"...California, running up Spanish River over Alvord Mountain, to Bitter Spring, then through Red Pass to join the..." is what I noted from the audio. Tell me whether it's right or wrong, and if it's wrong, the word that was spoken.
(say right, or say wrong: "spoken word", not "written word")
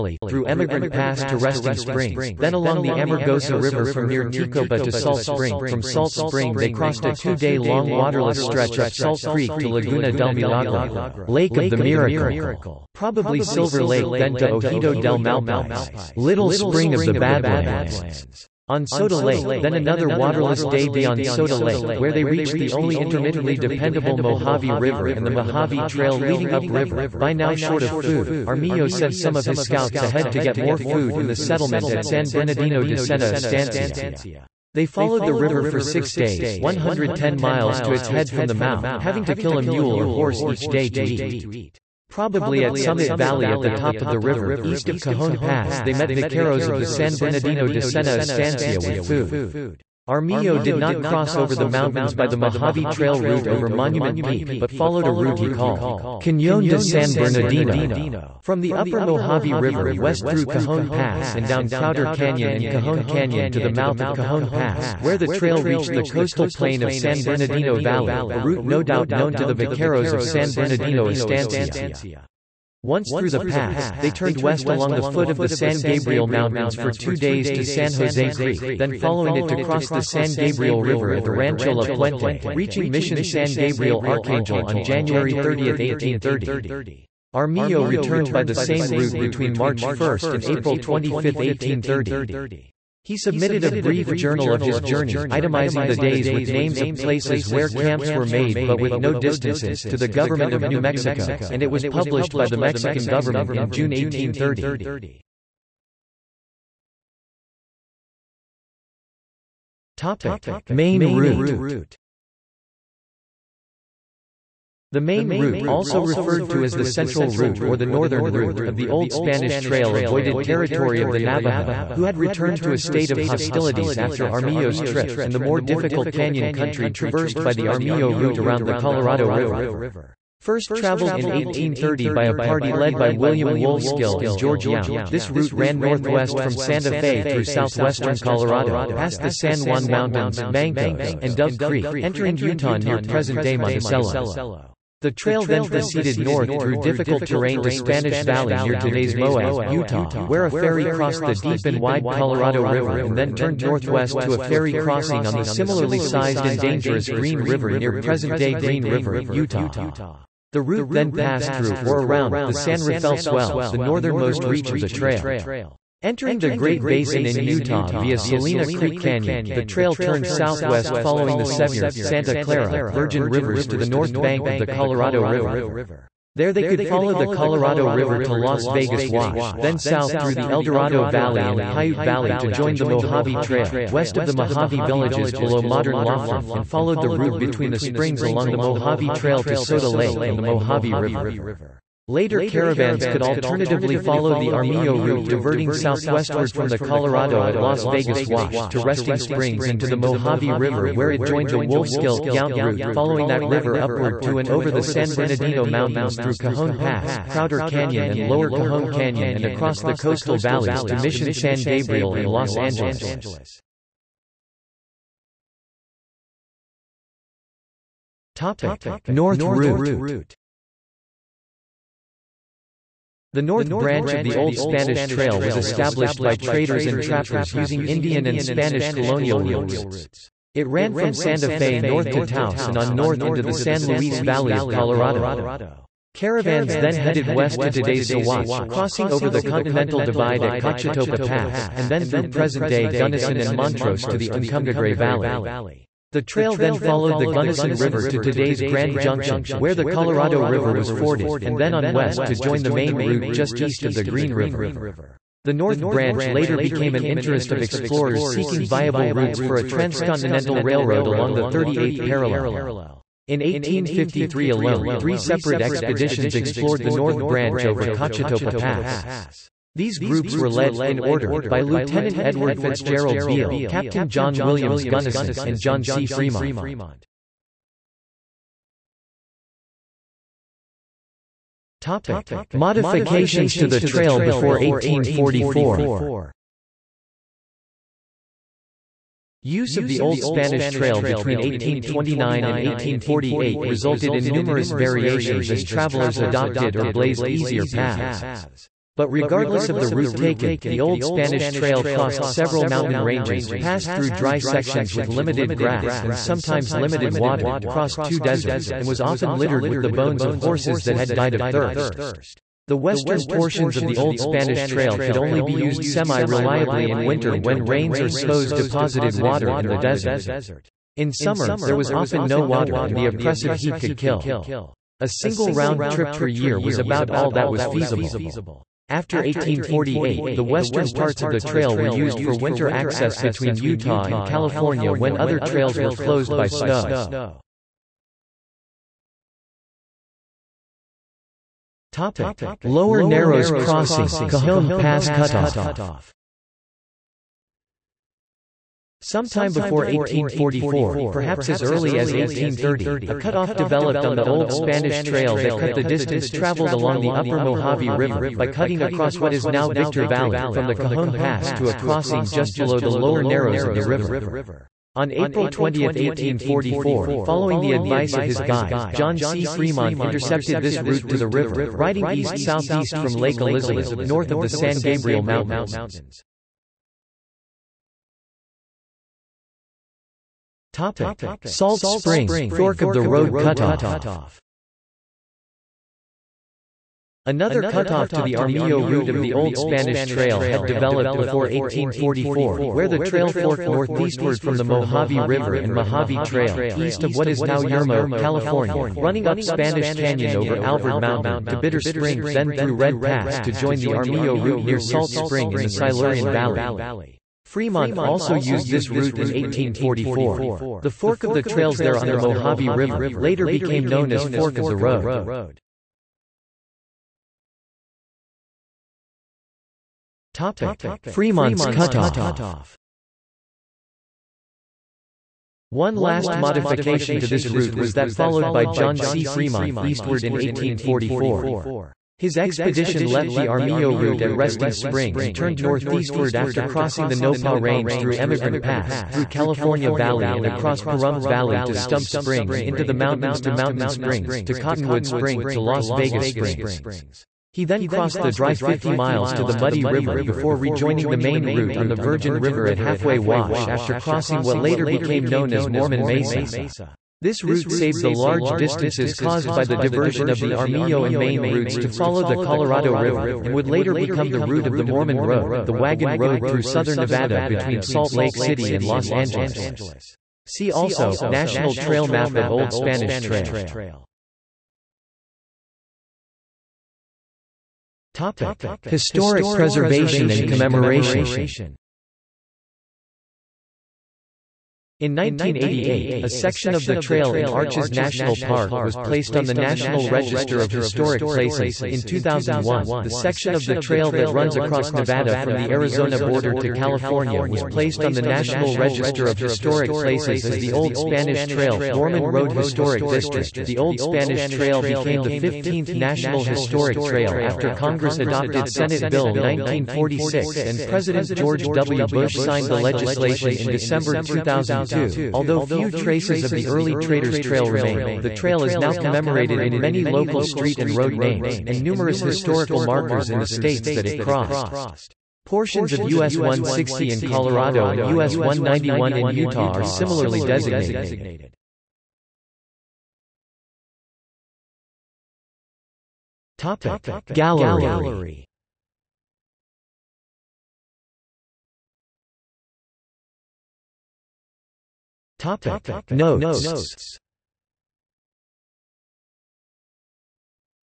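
wrong: "Canyon", not "River".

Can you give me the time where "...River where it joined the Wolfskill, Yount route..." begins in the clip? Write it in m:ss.
3:20.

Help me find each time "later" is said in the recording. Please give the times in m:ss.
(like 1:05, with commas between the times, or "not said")
3:12, 4:16, 6:53, 7:34, 7:43.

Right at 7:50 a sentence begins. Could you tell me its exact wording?
See also, National Trail Map of Old Spanish Trail.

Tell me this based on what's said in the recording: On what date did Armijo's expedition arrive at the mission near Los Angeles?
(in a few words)
January 30, 1830.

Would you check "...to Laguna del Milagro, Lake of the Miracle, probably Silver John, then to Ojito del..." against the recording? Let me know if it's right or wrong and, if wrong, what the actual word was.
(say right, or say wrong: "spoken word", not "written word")
wrong: "Lake", not "John".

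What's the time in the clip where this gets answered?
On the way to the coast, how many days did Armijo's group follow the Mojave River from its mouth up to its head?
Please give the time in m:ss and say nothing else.
0:35.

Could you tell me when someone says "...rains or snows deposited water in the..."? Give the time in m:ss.
5:17.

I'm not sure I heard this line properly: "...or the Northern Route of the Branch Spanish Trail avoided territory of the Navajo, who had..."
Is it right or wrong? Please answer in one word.
wrong.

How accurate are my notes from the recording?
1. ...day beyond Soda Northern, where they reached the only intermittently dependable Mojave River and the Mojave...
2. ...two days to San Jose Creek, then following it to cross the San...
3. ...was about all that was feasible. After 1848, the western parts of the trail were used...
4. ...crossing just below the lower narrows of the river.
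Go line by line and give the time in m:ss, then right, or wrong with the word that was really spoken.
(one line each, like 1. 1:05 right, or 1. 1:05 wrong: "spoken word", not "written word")
1. 0:20 wrong: "Lake", not "Northern"
2. 1:16 right
3. 5:26 right
4. 6:01 right.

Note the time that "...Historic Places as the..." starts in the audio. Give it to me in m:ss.
8:19.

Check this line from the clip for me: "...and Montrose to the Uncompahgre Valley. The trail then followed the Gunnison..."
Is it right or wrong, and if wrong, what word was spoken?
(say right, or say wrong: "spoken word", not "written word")
right.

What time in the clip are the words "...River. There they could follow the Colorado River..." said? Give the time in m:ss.
2:55.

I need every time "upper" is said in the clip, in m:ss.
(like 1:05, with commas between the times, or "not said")
0:58, 5:57.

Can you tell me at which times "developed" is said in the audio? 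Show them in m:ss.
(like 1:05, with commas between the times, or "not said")
5:53, 6:30.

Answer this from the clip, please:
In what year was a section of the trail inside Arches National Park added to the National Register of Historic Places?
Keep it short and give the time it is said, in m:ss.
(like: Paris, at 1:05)
1988, at 8:05.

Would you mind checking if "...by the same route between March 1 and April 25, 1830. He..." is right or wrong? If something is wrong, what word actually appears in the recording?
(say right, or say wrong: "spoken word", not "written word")
right.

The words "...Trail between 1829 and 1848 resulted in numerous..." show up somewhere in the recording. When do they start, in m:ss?
4:50.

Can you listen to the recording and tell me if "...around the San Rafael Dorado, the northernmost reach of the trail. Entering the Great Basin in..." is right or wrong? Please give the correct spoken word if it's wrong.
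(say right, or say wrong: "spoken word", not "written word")
wrong: "Swell", not "Dorado".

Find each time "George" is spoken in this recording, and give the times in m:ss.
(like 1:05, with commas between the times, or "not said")
2:14, 8:31.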